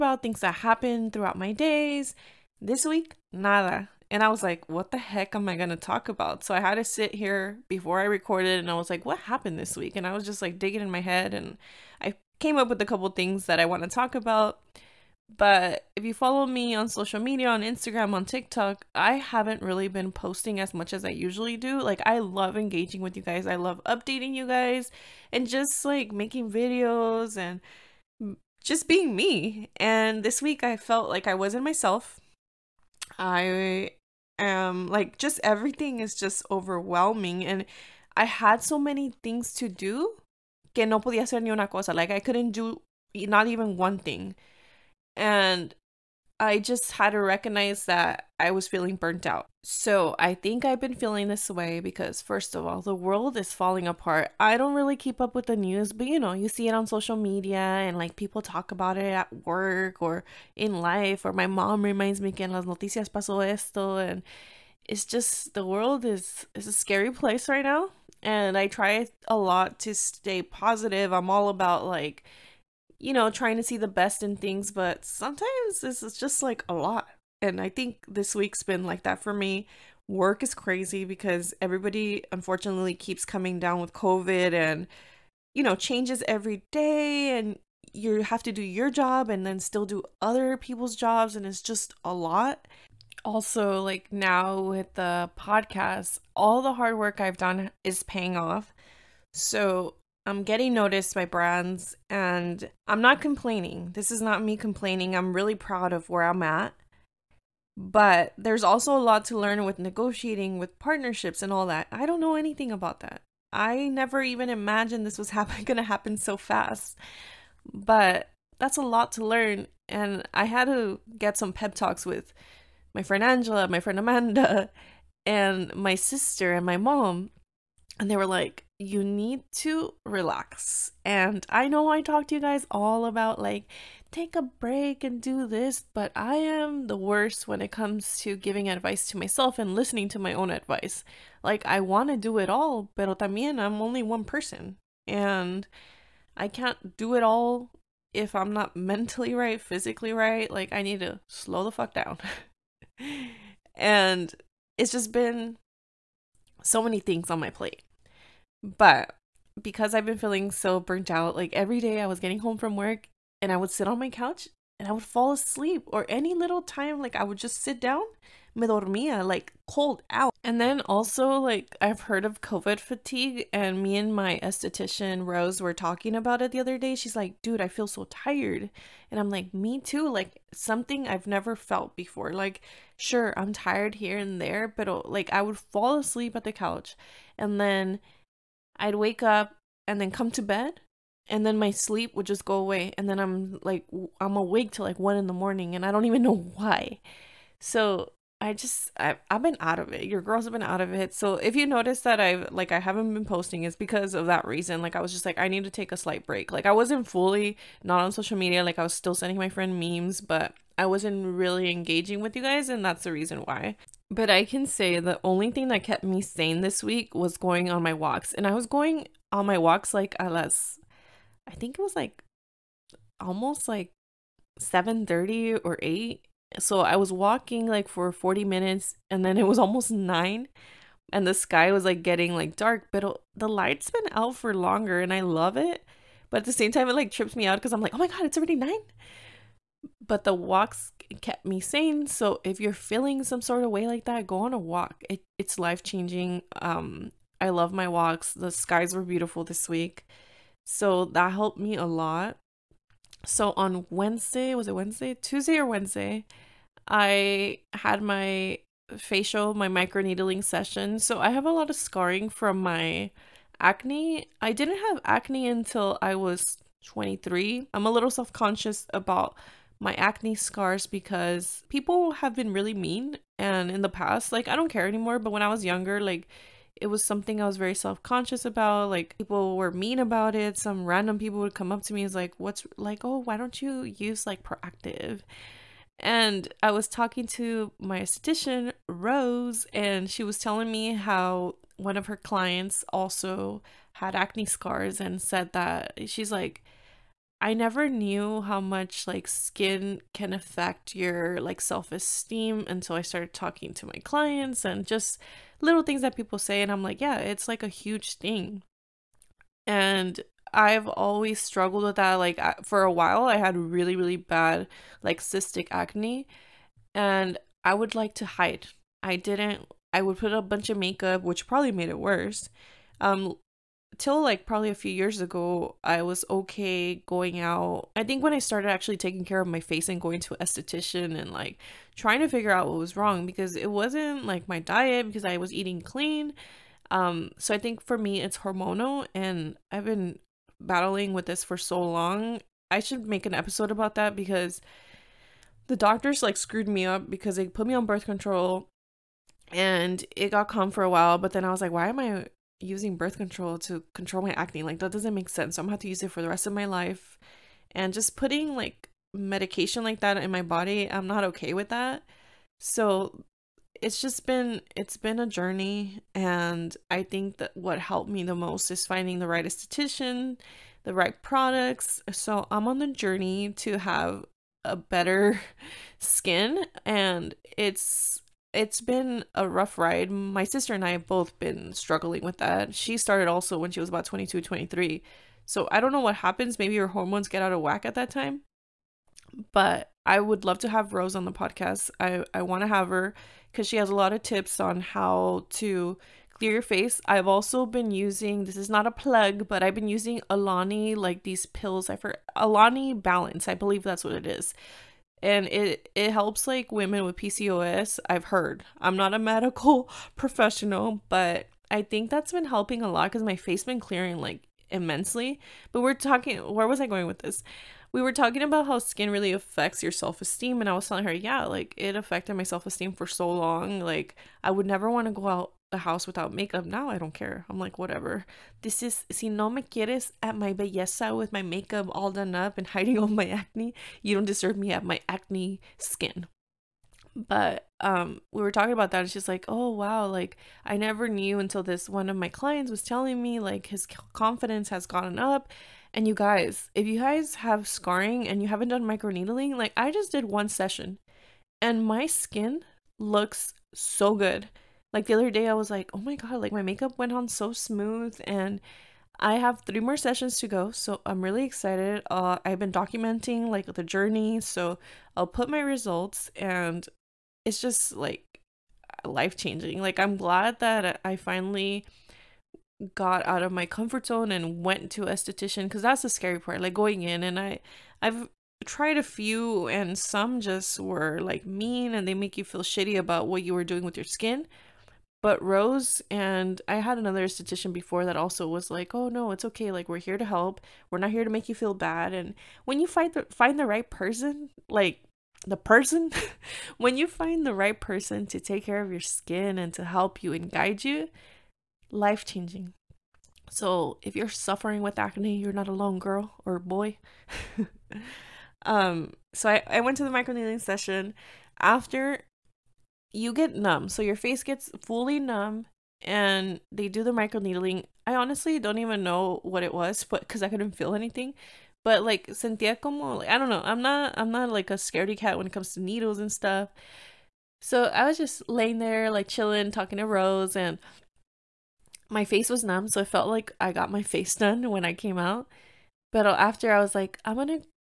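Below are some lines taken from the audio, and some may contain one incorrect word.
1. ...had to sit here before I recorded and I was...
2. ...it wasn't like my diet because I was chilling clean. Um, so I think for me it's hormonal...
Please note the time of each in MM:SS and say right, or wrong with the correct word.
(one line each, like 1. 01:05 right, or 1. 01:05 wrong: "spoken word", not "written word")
1. 00:06 right
2. 05:33 wrong: "eating", not "chilling".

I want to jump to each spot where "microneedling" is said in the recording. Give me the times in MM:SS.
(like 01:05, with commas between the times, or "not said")
04:19, 07:28, 08:30, 08:37.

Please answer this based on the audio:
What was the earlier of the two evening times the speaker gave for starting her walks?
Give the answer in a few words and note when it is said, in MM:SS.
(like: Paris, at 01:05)
7:30, at 03:44.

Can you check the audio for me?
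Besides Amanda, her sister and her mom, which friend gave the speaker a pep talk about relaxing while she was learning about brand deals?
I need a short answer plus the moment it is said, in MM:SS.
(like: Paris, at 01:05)
Angela, at 02:03.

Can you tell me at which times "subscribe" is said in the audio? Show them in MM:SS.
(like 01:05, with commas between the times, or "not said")
not said.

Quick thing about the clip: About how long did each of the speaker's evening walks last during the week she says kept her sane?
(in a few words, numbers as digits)
40 minutes.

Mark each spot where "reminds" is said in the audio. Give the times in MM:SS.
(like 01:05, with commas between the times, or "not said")
01:01.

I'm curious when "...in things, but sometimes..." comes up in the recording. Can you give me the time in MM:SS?
01:14.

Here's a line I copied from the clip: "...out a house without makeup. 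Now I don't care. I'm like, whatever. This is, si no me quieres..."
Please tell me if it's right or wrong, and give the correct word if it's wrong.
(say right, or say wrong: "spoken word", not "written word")
right.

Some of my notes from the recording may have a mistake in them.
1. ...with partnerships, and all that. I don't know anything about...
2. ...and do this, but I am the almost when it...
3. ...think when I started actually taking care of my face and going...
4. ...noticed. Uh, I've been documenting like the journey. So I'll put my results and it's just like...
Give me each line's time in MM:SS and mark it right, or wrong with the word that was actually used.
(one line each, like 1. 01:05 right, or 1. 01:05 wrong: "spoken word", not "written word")
1. 01:50 right
2. 02:15 wrong: "worst", not "almost"
3. 05:28 right
4. 07:41 wrong: "excited", not "noticed".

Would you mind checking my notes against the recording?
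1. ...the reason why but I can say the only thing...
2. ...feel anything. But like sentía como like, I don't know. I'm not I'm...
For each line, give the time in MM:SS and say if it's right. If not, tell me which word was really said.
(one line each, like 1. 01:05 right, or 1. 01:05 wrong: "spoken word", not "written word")
1. 03:33 right
2. 08:40 right.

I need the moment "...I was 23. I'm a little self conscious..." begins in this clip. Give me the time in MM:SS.
04:26.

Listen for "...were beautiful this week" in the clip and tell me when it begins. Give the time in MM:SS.
04:08.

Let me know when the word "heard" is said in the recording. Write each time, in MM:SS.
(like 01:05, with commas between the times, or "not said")
02:52, 06:48.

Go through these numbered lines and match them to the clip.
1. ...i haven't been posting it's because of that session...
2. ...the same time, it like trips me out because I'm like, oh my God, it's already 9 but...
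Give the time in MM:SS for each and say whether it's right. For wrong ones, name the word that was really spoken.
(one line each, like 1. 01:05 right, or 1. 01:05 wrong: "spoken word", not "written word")
1. 03:22 wrong: "reason", not "session"
2. 03:56 right.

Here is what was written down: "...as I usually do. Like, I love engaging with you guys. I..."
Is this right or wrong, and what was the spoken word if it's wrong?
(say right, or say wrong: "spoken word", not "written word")
right.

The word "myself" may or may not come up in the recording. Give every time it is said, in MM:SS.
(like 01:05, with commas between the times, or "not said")
00:31, 02:19.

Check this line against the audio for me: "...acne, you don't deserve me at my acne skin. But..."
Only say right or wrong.
right.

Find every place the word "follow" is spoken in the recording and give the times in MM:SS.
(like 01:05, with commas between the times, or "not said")
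00:16.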